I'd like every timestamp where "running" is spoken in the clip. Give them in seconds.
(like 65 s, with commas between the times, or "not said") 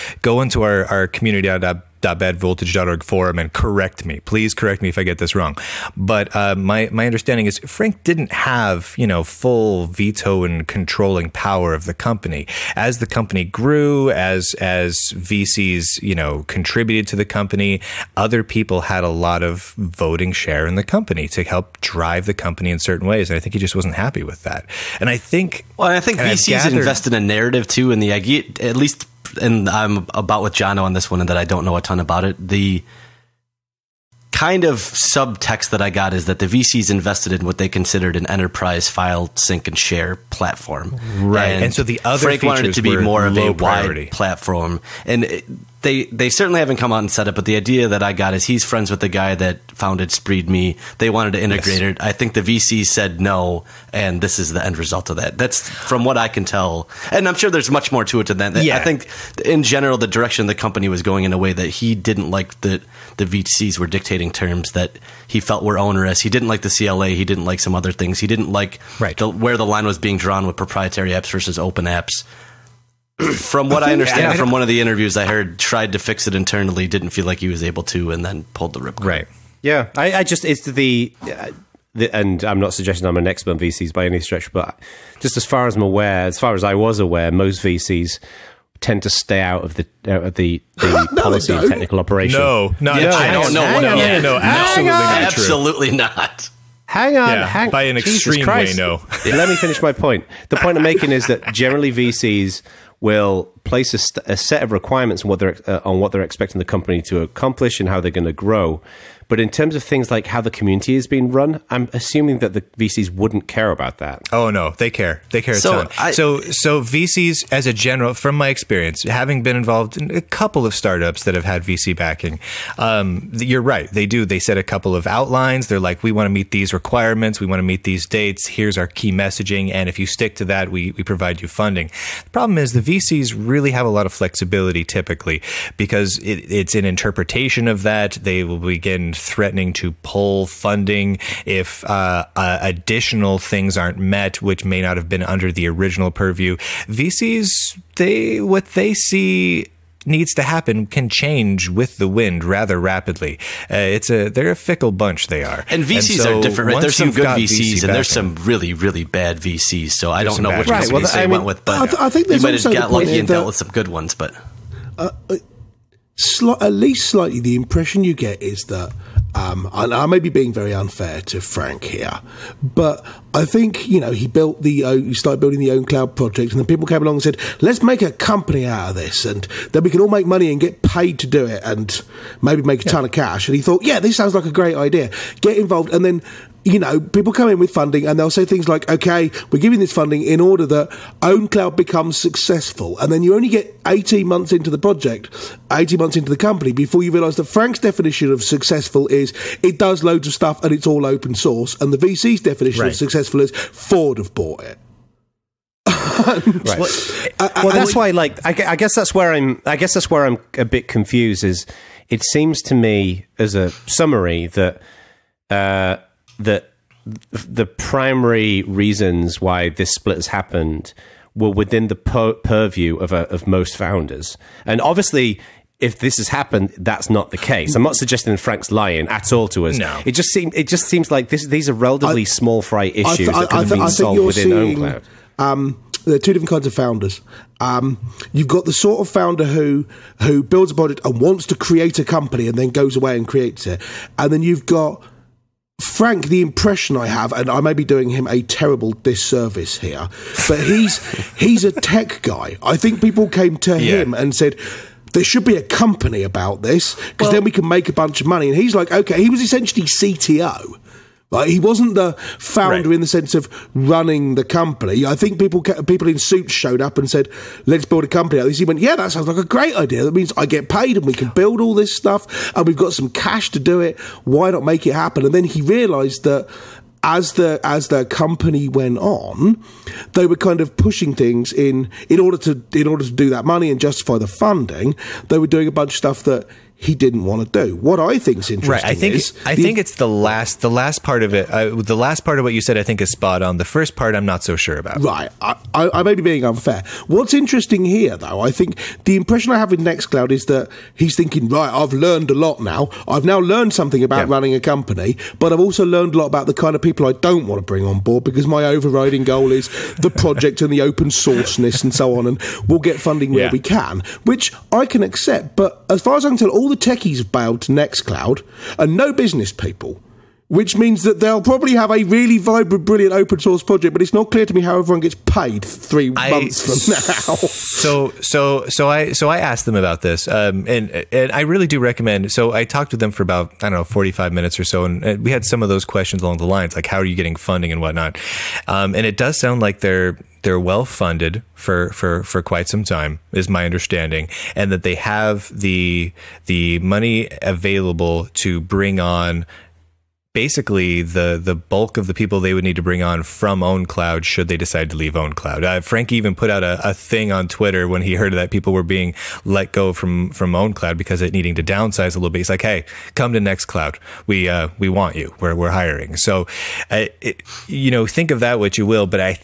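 263 s, 304 s.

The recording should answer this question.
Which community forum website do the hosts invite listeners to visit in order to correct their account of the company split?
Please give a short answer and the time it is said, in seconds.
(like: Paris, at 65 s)
badvoltage.org, at 2 s.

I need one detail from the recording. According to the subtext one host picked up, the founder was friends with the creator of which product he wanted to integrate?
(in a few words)
Spreed Me.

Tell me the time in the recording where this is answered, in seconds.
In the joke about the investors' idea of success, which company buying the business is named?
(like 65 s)
203 s.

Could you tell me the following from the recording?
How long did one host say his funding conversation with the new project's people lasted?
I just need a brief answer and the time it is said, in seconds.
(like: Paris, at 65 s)
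45 minutes, at 333 s.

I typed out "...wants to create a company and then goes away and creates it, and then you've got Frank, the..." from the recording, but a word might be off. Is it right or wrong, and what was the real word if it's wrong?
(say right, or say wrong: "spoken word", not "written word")
right.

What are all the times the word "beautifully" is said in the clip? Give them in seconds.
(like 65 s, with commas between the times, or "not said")
not said.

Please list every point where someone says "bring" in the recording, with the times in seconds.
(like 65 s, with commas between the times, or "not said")
307 s, 348 s, 352 s.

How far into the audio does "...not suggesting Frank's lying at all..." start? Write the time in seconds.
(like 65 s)
227 s.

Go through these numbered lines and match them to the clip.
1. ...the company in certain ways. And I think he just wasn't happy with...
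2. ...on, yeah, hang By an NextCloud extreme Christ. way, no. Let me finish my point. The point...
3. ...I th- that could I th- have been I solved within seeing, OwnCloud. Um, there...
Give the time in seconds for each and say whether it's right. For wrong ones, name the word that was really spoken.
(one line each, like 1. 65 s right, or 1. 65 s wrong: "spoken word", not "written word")
1. 22 s right
2. 97 s wrong: "Jesus", not "NextCloud"
3. 233 s right.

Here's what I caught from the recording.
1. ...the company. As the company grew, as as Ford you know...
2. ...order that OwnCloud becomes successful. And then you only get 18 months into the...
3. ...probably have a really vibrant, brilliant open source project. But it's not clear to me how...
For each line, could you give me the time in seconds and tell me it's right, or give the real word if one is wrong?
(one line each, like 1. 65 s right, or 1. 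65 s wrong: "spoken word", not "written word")
1. 11 s wrong: "VCs", not "Ford"
2. 190 s right
3. 321 s right.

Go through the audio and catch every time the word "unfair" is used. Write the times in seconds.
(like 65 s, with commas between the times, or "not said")
170 s, 296 s.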